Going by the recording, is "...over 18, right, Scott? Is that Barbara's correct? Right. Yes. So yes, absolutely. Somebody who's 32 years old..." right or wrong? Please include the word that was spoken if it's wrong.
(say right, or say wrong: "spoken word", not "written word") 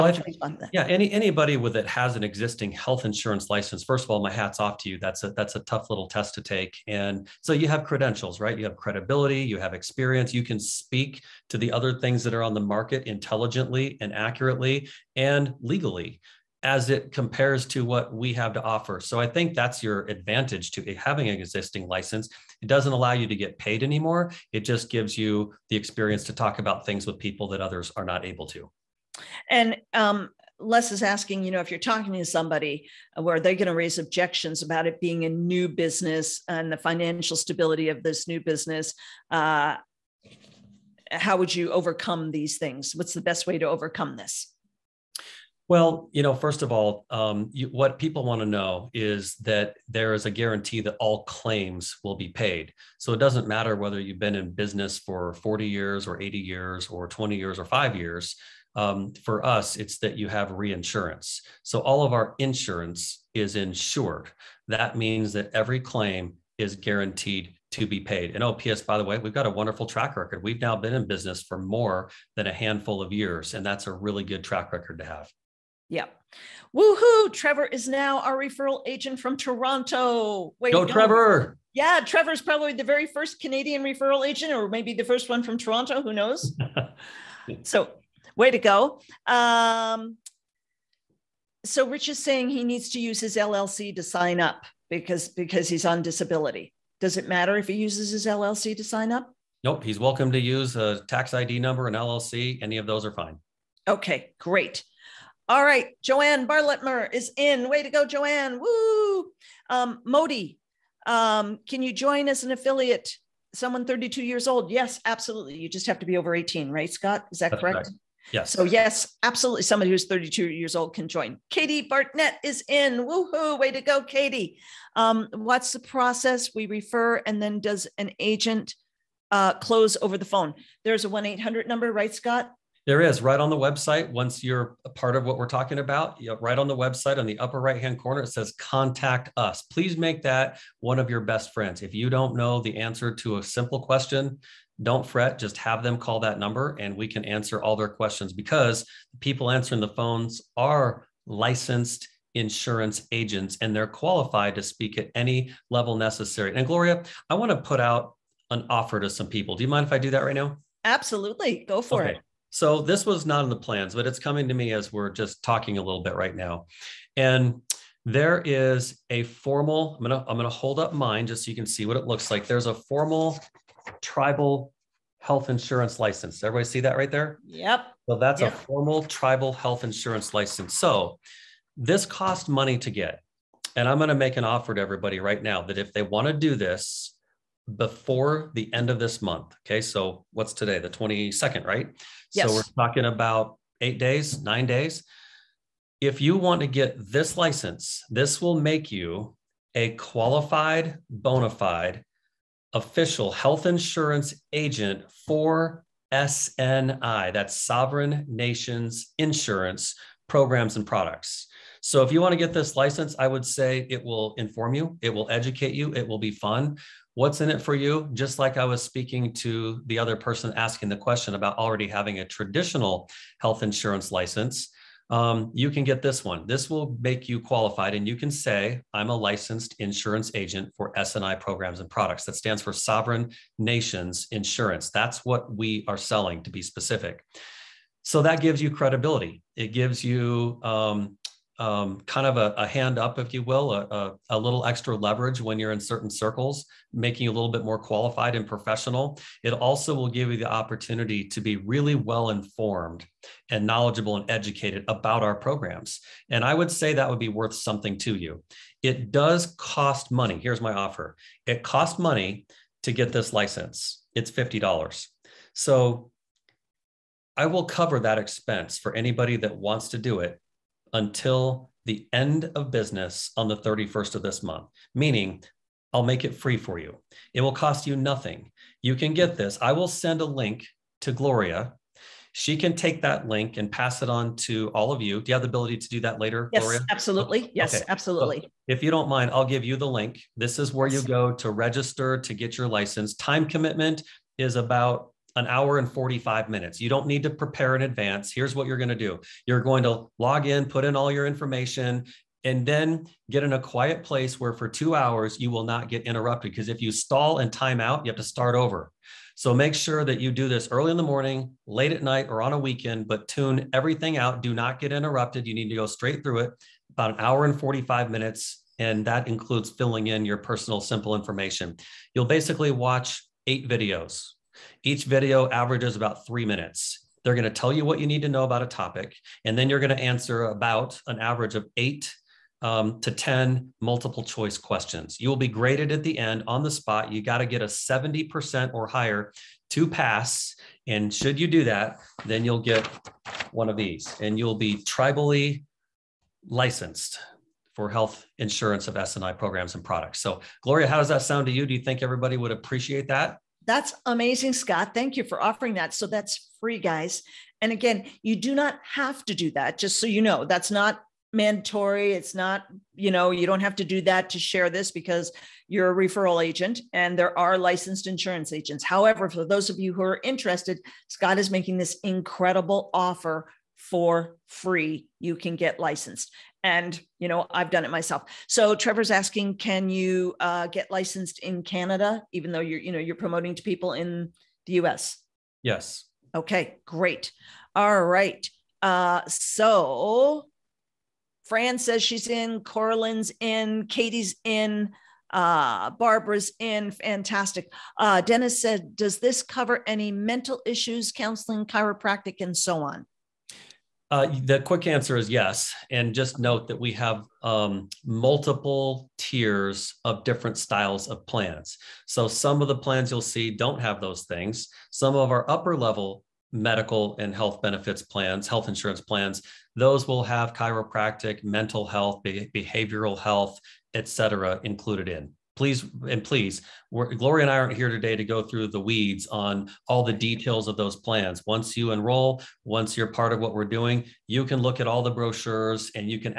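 wrong: "That", not "Barbara".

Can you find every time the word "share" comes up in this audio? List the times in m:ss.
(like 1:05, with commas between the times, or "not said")
6:04.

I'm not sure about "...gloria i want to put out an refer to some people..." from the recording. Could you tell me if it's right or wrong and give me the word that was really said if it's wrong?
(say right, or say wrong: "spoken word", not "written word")
wrong: "offer", not "refer".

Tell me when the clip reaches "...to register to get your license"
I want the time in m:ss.
4:51.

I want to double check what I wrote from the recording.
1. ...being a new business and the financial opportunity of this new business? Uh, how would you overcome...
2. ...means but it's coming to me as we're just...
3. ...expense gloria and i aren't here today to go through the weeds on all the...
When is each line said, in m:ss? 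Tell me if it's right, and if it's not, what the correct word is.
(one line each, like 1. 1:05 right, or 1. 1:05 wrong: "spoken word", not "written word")
1. 0:35 wrong: "stability", not "opportunity"
2. 2:43 wrong: "plans", not "means"
3. 7:06 wrong: "please", not "expense".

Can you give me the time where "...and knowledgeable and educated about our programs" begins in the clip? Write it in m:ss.
4:13.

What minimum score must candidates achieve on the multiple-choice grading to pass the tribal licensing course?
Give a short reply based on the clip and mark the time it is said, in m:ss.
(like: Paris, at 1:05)
70%, at 5:37.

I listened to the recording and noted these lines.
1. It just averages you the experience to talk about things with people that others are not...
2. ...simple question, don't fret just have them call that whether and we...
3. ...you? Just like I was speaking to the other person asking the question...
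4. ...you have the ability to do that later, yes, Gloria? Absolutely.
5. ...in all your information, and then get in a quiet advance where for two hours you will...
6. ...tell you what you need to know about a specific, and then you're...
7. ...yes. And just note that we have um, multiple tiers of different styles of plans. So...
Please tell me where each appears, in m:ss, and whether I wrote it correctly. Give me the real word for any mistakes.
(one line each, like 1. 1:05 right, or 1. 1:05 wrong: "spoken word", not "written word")
1. 0:24 wrong: "gives", not "averages"
2. 2:23 wrong: "number", not "whether"
3. 3:37 right
4. 4:45 right
5. 5:00 wrong: "place", not "advance"
6. 5:27 wrong: "topic", not "specific"
7. 6:45 right.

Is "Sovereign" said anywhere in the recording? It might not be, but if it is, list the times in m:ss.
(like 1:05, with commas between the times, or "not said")
3:27, 3:52.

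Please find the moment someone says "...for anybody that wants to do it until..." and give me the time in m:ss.
4:28.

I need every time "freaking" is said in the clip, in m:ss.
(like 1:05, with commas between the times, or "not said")
not said.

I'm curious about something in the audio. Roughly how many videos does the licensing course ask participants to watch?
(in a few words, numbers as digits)
8.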